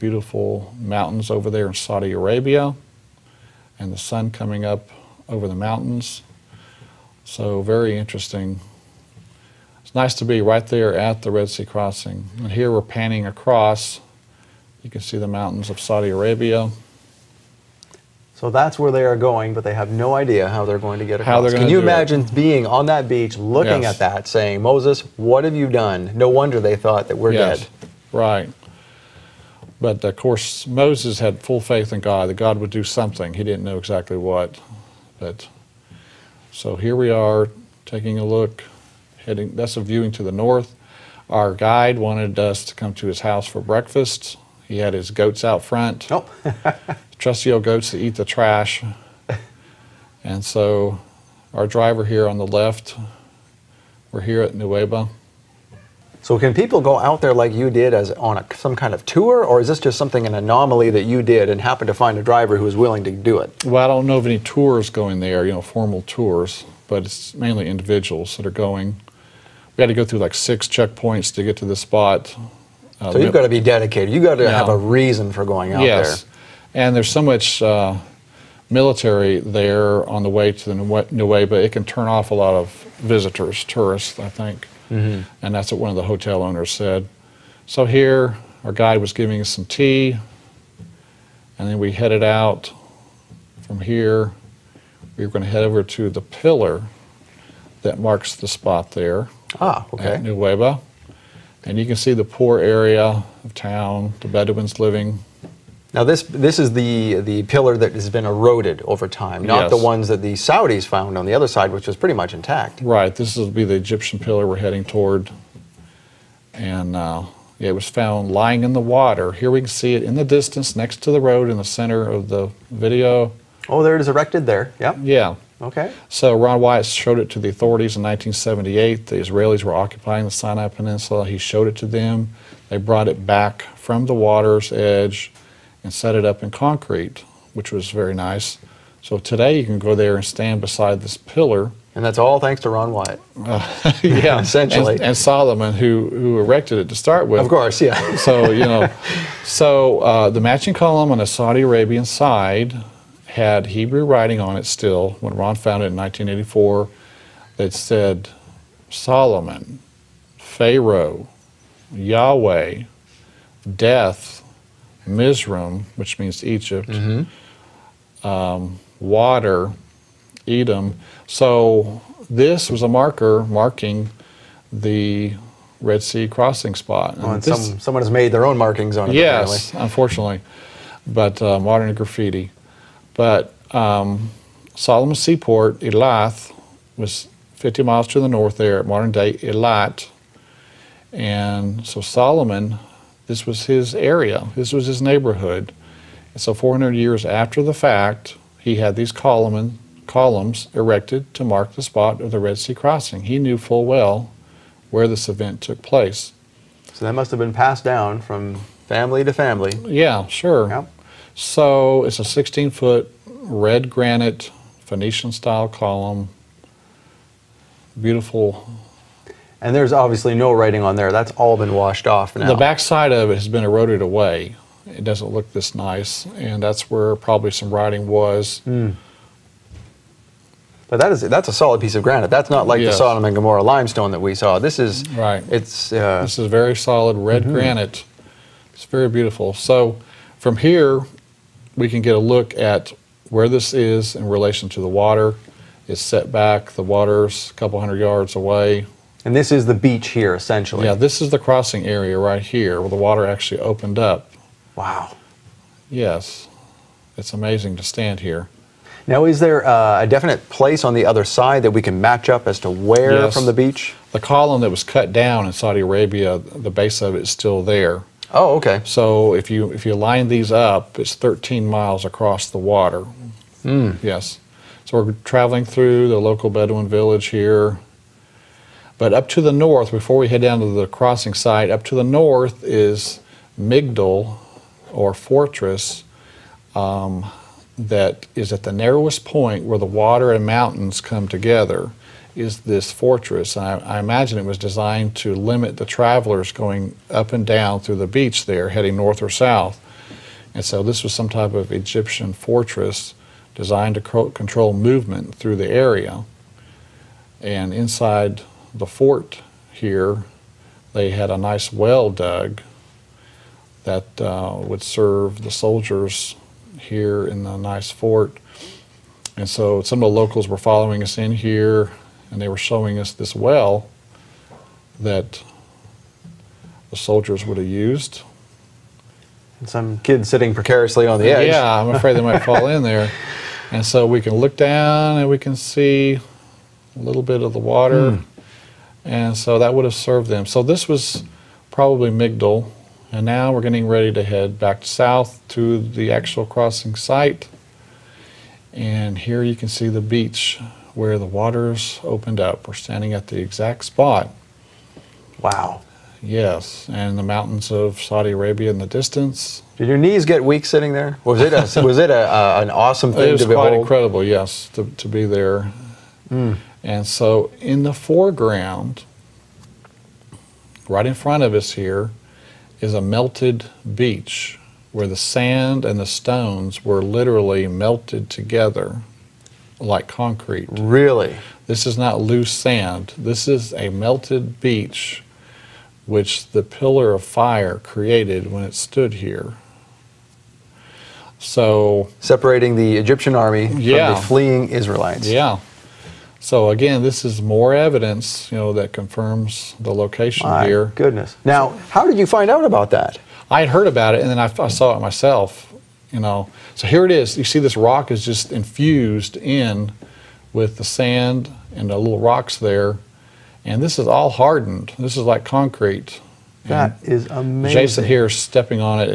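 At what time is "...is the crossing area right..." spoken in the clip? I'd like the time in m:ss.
4:11.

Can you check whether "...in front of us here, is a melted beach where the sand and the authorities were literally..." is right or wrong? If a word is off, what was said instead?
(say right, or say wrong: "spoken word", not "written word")
wrong: "stones", not "authorities".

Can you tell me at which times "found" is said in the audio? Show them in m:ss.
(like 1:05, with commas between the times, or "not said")
1:50, 1:57, 2:35.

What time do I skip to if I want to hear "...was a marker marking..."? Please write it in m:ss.
2:52.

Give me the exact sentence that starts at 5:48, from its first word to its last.
And here you can see the beach where the waters opened up.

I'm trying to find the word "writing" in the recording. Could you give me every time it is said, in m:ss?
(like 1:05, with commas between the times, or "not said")
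2:34, 3:40, 3:47.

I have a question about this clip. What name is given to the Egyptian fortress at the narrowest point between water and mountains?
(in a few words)
Migdol.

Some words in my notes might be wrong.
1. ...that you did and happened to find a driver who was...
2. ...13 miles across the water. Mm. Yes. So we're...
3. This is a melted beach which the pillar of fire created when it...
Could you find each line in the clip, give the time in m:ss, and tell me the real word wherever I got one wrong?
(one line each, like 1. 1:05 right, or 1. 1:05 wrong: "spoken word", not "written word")
1. 1:00 right
2. 4:31 right
3. 6:23 right.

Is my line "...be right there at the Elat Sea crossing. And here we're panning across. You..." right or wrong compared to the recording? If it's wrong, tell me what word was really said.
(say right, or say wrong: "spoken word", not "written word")
wrong: "Red", not "Elat".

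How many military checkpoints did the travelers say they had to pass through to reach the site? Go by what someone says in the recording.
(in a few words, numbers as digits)
6.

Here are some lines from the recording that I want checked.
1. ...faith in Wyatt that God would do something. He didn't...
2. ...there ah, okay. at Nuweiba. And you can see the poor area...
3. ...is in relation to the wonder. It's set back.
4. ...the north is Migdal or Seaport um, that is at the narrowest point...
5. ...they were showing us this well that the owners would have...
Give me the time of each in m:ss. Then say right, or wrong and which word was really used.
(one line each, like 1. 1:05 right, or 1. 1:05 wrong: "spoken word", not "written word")
1. 0:31 wrong: "God", not "Wyatt"
2. 1:38 right
3. 4:03 wrong: "water", not "wonder"
4. 4:41 wrong: "Fortress", not "Seaport"
5. 5:22 wrong: "soldiers", not "owners".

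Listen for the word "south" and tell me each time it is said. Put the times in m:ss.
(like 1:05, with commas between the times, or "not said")
4:59, 5:44.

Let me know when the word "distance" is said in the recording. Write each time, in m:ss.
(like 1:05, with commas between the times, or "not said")
2:00, 5:58.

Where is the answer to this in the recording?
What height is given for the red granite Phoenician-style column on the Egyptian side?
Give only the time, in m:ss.
3:32.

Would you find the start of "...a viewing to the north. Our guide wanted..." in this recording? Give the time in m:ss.
0:39.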